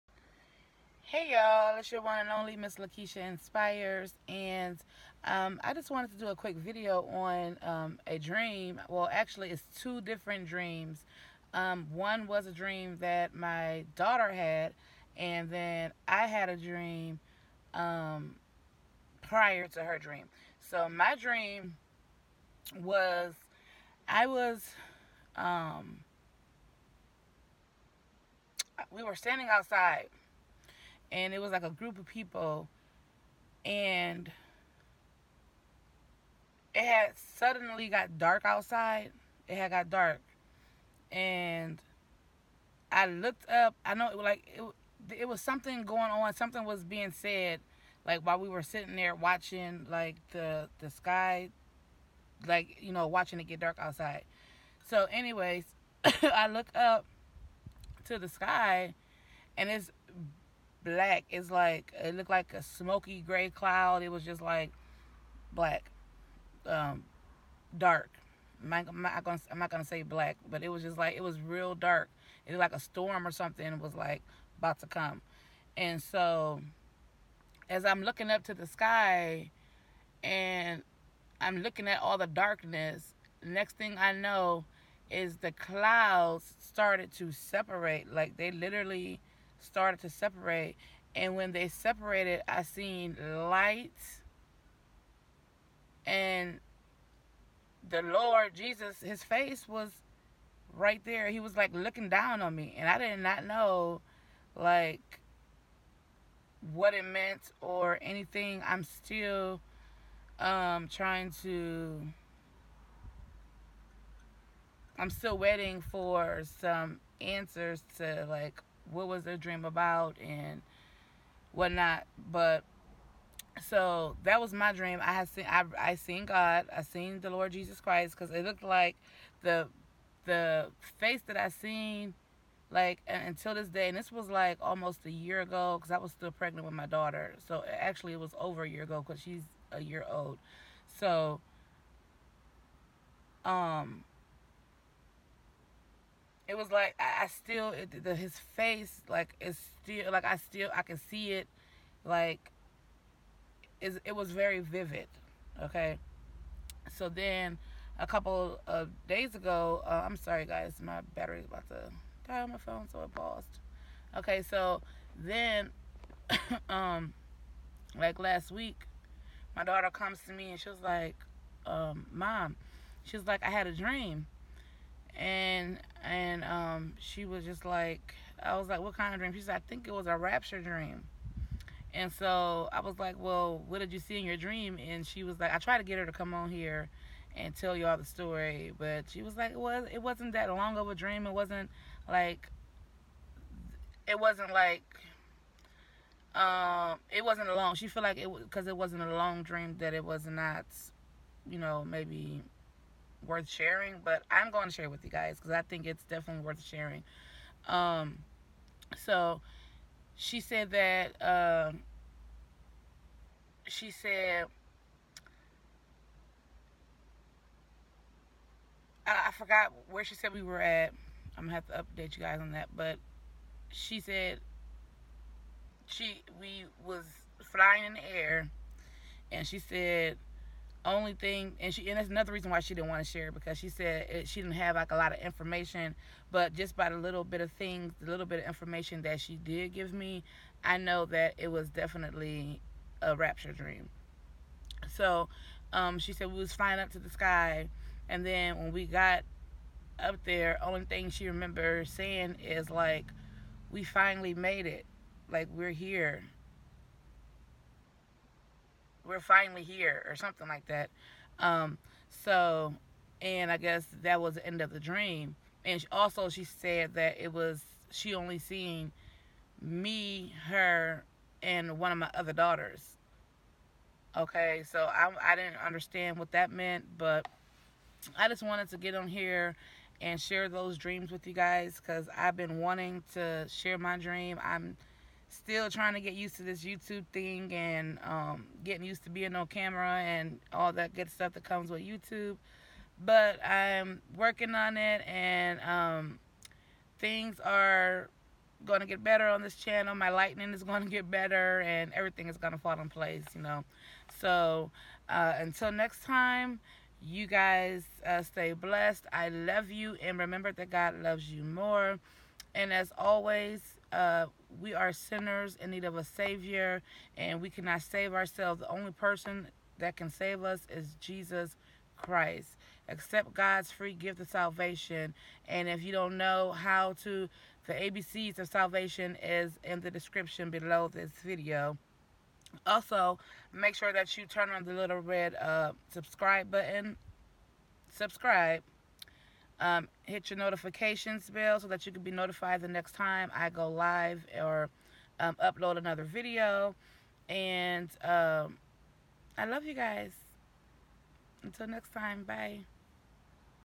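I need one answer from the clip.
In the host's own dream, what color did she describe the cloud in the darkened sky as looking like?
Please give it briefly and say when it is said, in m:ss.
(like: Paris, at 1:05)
smoky gray, at 1:02.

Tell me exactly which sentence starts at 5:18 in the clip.
The only person that can save us is Jesus Christ.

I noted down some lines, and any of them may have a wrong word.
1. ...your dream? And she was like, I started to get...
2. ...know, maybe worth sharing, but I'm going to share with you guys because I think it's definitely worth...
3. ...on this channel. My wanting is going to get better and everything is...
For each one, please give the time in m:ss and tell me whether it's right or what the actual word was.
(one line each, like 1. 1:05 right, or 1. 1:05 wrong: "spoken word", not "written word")
1. 3:04 wrong: "tried", not "started"
2. 3:21 right
3. 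4:59 wrong: "lightning", not "wanting".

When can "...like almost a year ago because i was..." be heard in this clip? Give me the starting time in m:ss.
2:14.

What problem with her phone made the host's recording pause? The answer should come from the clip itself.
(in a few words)
battery about to die.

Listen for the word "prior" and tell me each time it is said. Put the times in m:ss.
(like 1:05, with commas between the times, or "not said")
0:19.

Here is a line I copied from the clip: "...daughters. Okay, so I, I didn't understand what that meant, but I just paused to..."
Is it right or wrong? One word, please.
wrong.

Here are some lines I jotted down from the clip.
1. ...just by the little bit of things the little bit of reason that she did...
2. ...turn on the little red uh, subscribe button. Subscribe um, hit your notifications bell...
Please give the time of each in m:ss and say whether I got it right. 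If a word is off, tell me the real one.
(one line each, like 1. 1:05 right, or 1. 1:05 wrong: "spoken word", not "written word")
1. 3:56 wrong: "information", not "reason"
2. 5:34 right.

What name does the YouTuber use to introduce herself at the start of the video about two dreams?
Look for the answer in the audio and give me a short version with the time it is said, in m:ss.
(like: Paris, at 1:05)
Miss Lakeisha Inspires, at 0:02.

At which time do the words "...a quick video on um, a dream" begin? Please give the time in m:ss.
0:06.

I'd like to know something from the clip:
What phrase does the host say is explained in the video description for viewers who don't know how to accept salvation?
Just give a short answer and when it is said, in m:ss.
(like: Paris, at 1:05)
the ABCs of salvation, at 5:27.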